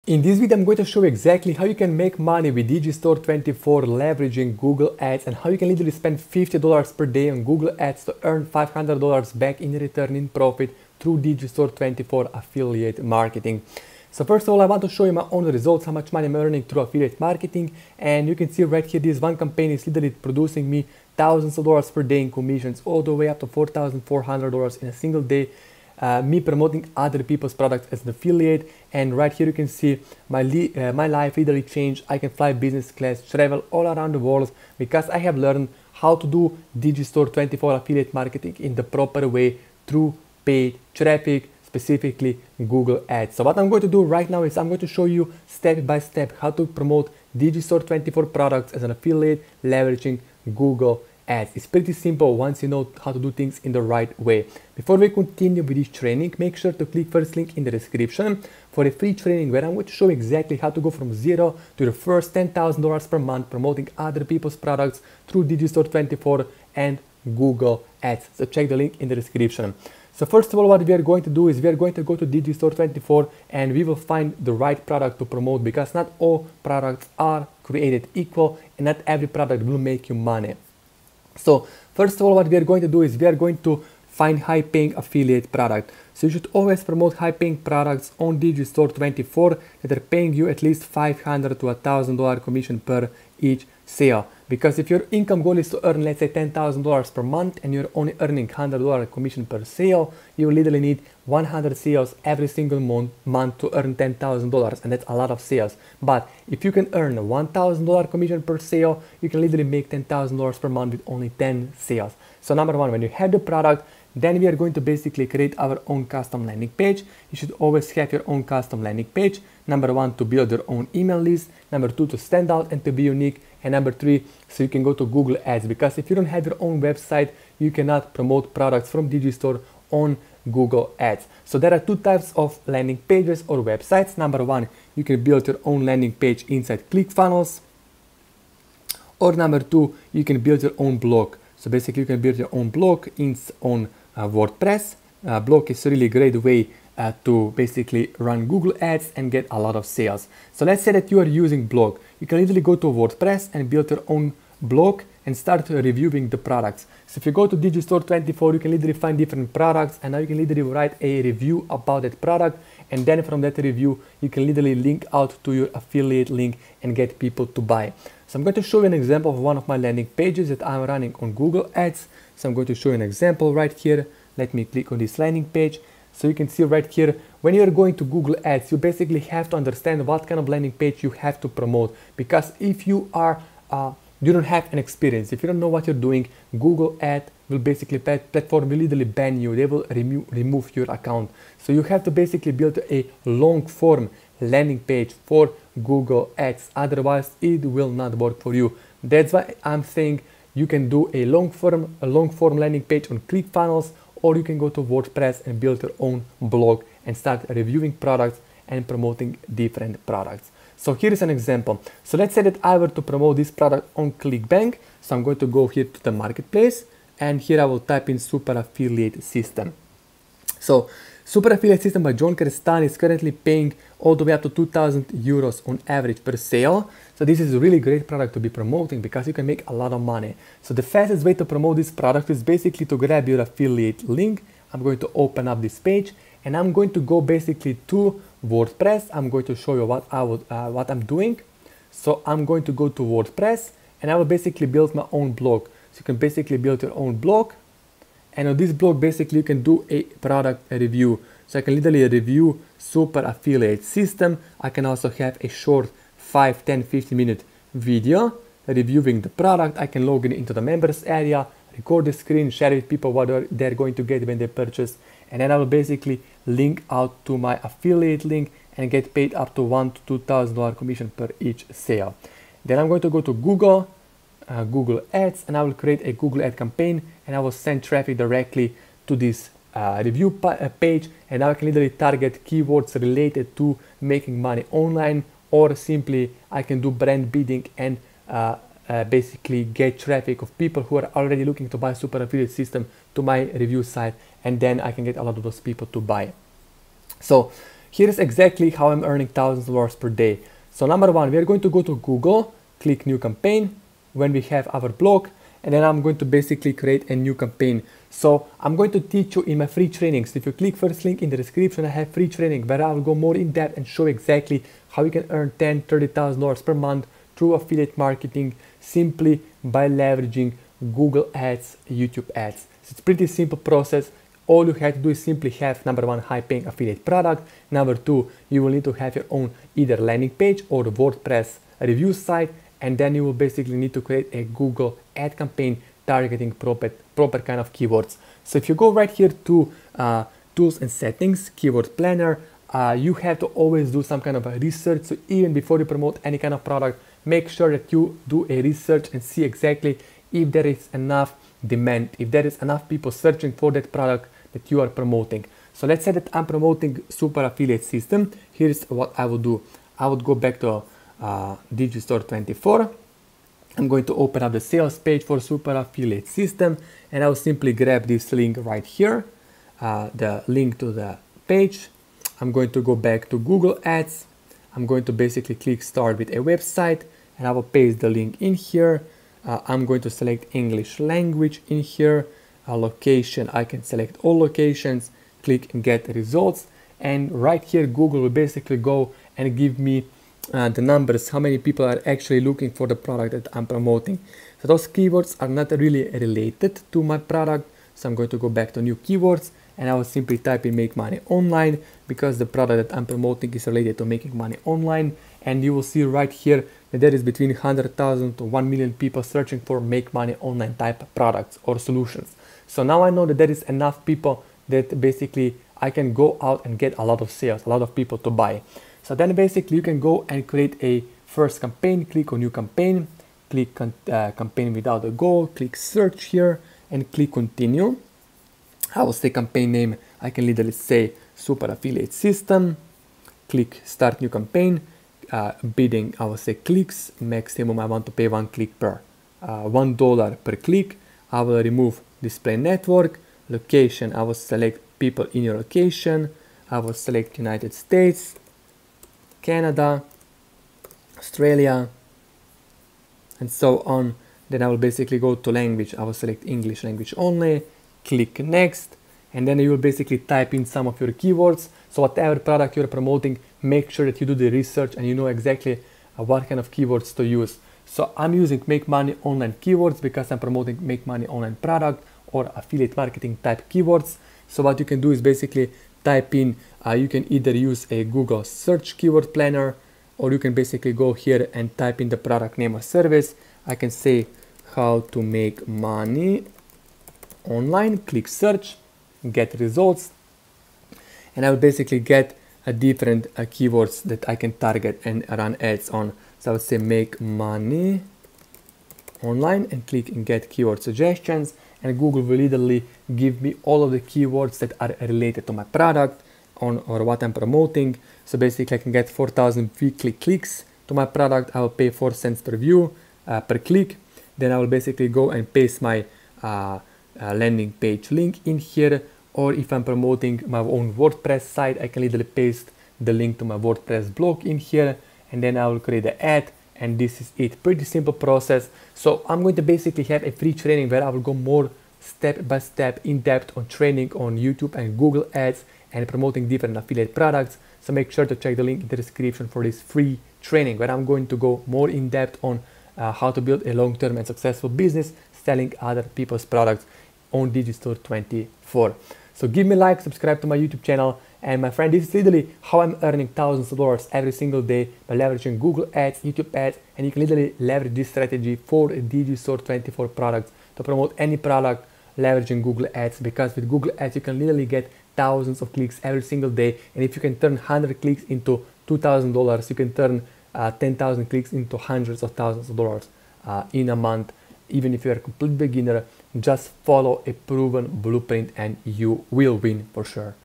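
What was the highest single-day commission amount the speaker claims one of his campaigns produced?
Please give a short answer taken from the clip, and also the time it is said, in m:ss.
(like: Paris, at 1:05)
$4,400, at 0:23.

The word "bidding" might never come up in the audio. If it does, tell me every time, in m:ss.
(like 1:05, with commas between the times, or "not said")
4:47, 7:15.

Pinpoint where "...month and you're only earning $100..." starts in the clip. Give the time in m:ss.
1:37.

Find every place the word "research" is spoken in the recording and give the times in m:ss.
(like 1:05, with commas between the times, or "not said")
5:44, 5:48, 7:44.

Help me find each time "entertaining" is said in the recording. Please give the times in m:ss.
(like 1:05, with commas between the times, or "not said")
not said.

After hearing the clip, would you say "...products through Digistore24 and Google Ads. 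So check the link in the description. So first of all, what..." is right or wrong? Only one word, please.
right.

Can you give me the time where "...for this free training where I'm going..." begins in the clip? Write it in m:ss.
8:59.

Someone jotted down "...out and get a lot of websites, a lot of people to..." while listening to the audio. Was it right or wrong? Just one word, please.
wrong.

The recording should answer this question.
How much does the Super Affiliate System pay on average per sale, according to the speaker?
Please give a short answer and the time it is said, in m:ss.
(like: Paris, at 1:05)
2000 euros, at 3:44.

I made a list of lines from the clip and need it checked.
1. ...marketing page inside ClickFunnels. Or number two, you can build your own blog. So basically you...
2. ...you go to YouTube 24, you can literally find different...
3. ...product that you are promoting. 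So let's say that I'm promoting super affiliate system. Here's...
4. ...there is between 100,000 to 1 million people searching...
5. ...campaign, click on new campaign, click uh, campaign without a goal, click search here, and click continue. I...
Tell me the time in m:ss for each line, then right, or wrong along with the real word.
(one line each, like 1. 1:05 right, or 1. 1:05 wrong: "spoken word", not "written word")
1. 2:15 wrong: "landing", not "marketing"
2. 2:37 wrong: "Digistore", not "YouTube"
3. 5:53 right
4. 6:47 right
5. 7:01 right.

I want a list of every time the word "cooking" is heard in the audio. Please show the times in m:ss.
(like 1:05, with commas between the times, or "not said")
not said.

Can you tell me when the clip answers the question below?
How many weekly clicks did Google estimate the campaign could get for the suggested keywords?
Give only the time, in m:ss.
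8:29.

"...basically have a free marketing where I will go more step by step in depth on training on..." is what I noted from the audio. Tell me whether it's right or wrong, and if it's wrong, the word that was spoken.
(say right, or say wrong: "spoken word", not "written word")
wrong: "training", not "marketing".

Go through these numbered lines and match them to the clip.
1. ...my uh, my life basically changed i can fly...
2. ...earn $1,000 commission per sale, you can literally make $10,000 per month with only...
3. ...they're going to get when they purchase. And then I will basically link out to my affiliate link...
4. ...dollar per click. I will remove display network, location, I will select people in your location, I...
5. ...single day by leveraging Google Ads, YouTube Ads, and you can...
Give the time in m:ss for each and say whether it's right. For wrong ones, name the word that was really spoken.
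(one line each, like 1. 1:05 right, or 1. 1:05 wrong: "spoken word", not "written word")
1. 0:30 wrong: "literally", not "basically"
2. 1:46 right
3. 4:23 right
4. 7:19 right
5. 9:14 right.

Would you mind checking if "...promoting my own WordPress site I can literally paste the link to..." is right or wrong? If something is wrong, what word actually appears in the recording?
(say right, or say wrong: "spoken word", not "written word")
right.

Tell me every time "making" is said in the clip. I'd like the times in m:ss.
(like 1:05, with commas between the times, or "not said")
4:44, 6:44.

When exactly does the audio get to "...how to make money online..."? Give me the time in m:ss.
8:04.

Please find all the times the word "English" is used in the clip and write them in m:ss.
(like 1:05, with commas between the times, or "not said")
6:20, 7:36.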